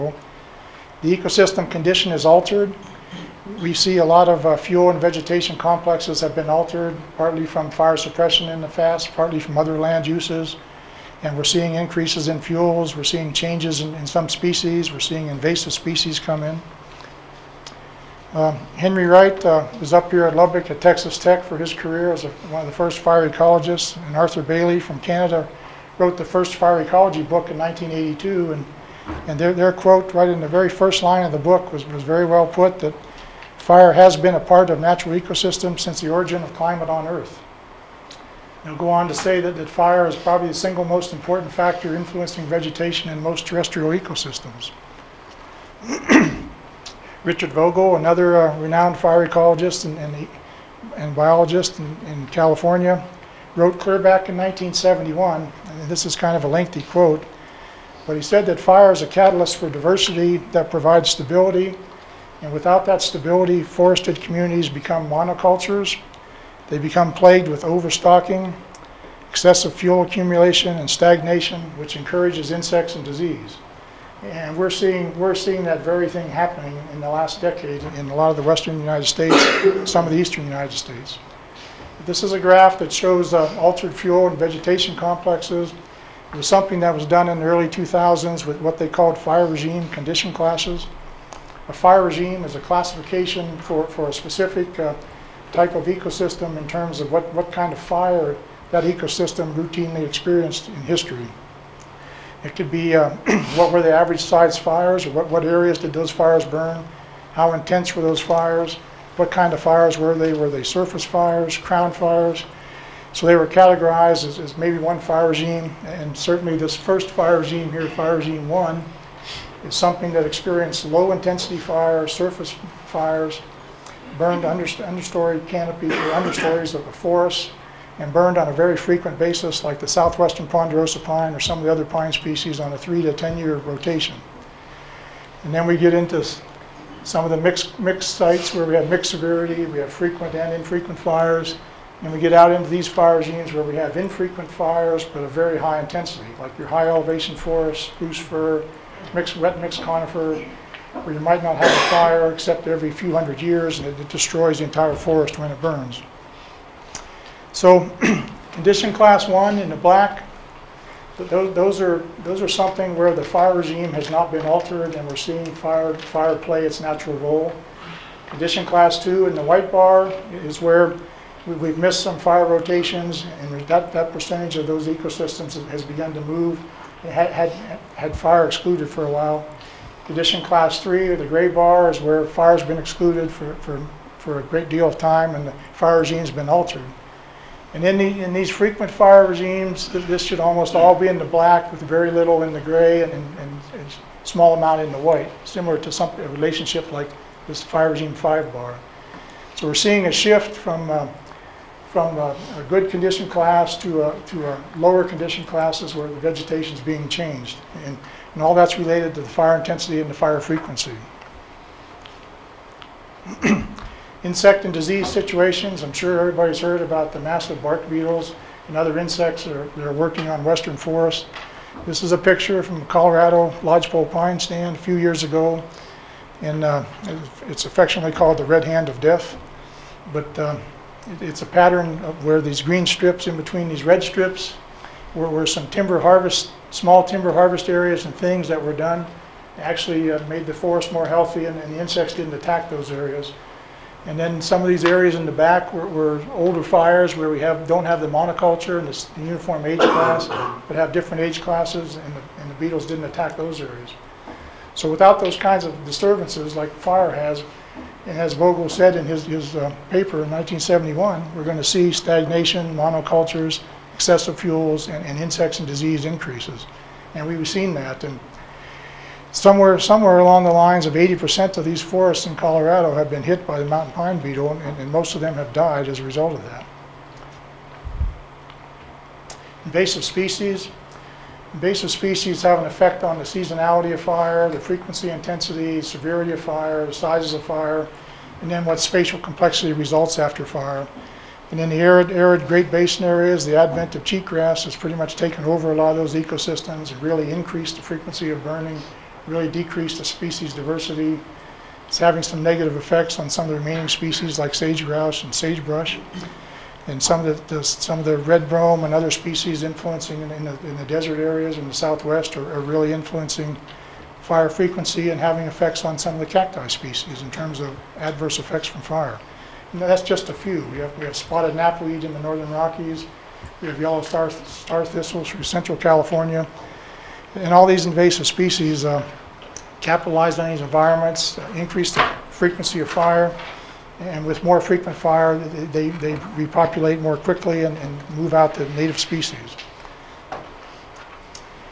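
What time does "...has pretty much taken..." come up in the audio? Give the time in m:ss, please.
4:54.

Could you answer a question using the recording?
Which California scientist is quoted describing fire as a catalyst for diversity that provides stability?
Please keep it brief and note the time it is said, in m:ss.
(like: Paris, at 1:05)
Richard Vogl, at 0:47.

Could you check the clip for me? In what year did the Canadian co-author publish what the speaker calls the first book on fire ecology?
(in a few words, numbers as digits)
1982.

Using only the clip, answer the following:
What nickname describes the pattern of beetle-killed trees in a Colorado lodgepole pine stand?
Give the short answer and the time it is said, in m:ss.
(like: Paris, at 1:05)
red hand of death, at 3:48.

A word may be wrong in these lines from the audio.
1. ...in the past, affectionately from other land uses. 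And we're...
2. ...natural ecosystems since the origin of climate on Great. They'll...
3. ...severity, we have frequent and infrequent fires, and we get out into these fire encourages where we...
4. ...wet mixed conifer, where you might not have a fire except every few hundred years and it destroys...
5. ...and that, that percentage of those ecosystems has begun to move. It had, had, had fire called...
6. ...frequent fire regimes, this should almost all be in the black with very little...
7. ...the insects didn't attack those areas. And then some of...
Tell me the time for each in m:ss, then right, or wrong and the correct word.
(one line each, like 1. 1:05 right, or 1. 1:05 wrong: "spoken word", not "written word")
1. 0:08 wrong: "partly", not "affectionately"
2. 0:34 wrong: "Earth", not "Great"
3. 2:19 wrong: "regimes", not "encourages"
4. 2:29 right
5. 2:53 wrong: "excluded", not "called"
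6. 3:08 right
7. 4:01 right.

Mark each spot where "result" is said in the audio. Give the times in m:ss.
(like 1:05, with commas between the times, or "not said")
4:36, 4:49.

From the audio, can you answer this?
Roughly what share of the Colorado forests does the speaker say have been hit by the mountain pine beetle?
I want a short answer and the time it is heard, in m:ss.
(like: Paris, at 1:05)
80%, at 4:30.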